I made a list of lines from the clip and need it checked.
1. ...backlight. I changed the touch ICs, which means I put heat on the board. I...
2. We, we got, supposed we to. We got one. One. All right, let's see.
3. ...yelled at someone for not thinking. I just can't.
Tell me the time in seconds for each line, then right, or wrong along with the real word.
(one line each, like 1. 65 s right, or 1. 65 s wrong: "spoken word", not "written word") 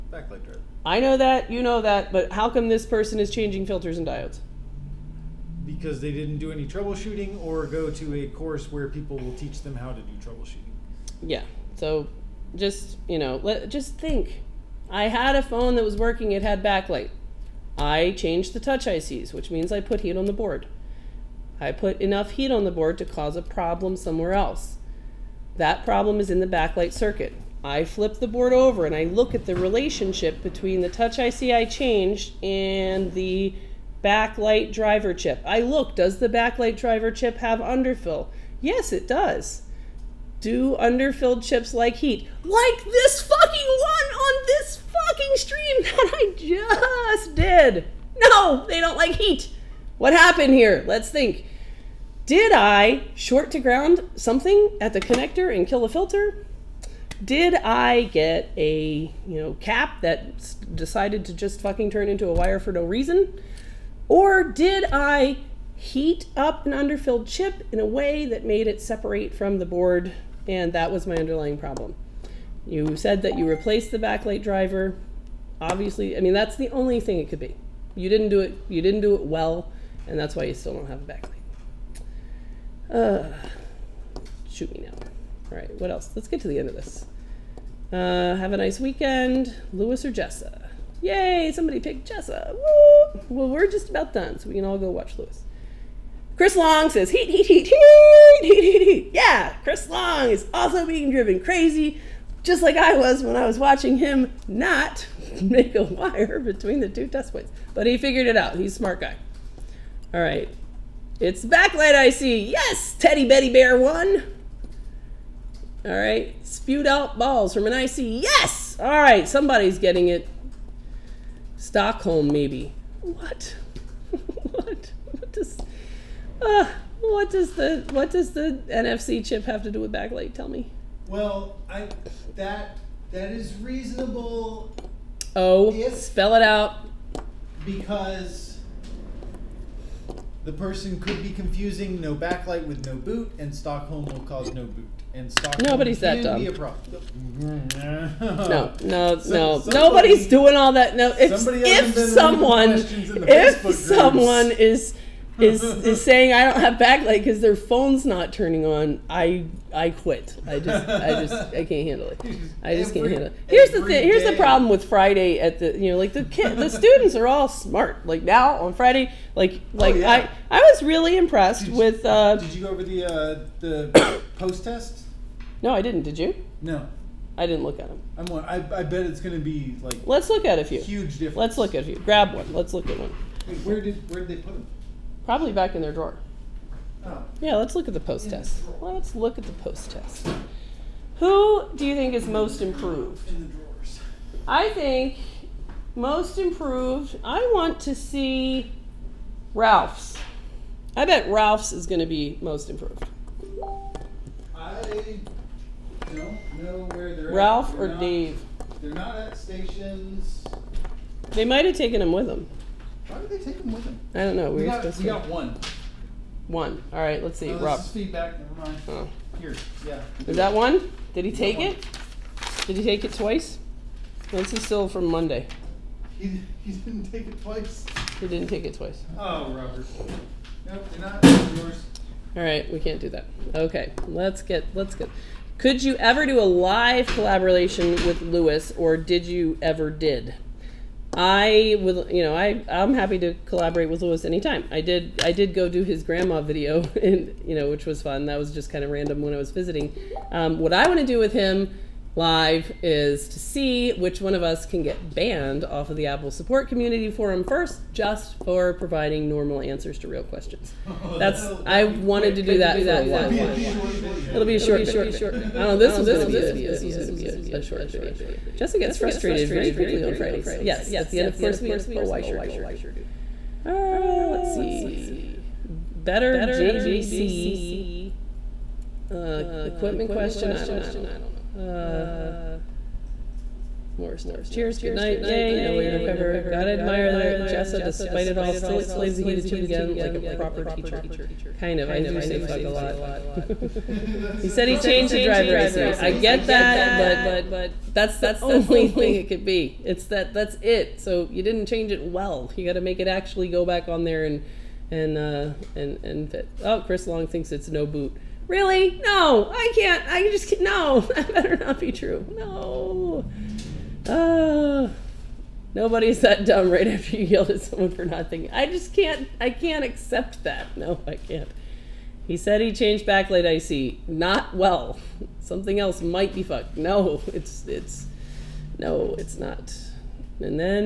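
1. 16 s right
2. 214 s right
3. 317 s right.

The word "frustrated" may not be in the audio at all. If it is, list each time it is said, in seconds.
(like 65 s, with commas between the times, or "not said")
268 s.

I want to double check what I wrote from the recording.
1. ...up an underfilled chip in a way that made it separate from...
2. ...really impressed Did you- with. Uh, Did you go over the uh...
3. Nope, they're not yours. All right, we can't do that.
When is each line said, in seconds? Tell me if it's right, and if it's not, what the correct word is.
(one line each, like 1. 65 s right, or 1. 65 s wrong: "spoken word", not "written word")
1. 66 s right
2. 170 s right
3. 230 s right.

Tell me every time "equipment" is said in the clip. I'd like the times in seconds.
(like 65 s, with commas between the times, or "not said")
279 s.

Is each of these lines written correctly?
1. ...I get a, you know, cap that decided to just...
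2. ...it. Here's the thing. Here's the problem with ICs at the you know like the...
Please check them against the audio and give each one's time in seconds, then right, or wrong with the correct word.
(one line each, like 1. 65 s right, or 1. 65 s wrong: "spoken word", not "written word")
1. 57 s right
2. 163 s wrong: "Friday", not "ICs".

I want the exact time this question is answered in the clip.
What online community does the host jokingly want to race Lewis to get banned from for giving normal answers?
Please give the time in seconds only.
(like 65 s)
256 s.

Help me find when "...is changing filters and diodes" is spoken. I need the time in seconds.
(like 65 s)
3 s.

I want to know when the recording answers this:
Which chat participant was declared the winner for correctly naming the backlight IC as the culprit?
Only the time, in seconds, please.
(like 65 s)
112 s.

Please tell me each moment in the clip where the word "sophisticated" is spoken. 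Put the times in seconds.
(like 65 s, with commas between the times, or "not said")
not said.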